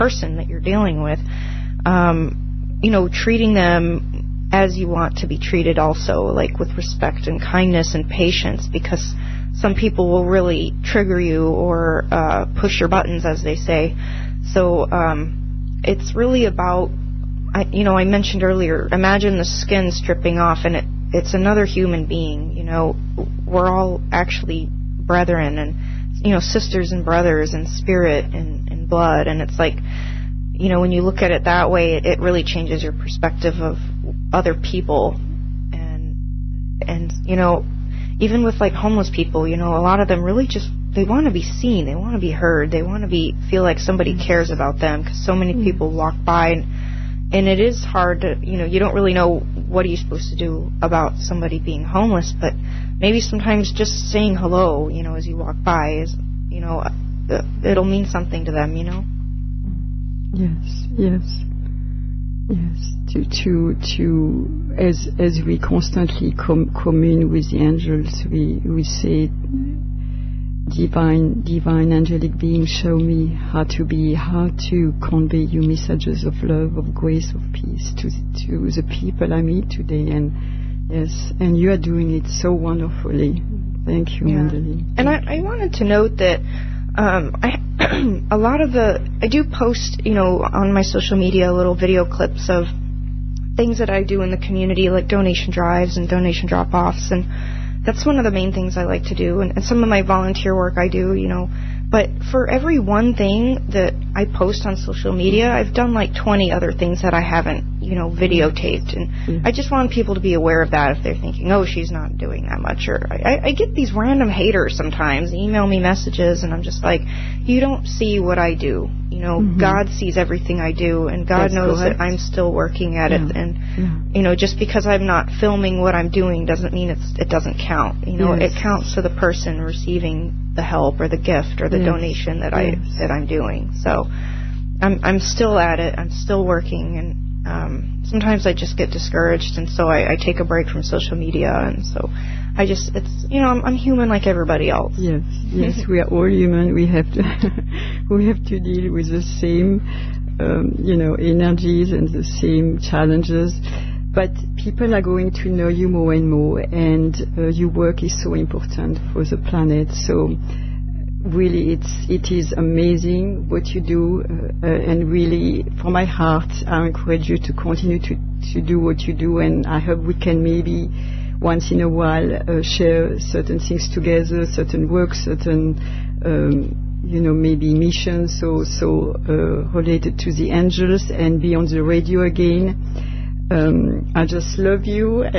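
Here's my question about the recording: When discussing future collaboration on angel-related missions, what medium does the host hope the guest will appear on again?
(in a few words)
the radio.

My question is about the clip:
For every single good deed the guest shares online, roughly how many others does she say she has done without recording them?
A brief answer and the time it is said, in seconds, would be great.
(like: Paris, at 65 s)
20, at 106 s.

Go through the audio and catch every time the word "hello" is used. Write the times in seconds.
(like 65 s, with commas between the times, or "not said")
54 s.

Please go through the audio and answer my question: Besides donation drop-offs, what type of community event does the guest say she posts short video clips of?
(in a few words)
donation drives.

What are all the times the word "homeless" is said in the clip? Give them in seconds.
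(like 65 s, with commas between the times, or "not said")
38 s, 51 s.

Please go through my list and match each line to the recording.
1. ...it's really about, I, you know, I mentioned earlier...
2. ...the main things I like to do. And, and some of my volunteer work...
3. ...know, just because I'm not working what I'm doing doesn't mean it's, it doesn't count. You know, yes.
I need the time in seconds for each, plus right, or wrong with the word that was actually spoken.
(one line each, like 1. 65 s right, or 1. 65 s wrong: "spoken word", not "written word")
1. 15 s right
2. 98 s right
3. 124 s wrong: "filming", not "working".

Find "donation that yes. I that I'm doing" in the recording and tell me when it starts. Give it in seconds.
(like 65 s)
131 s.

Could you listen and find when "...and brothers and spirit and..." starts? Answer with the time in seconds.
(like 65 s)
26 s.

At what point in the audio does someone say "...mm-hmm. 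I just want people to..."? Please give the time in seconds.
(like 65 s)
109 s.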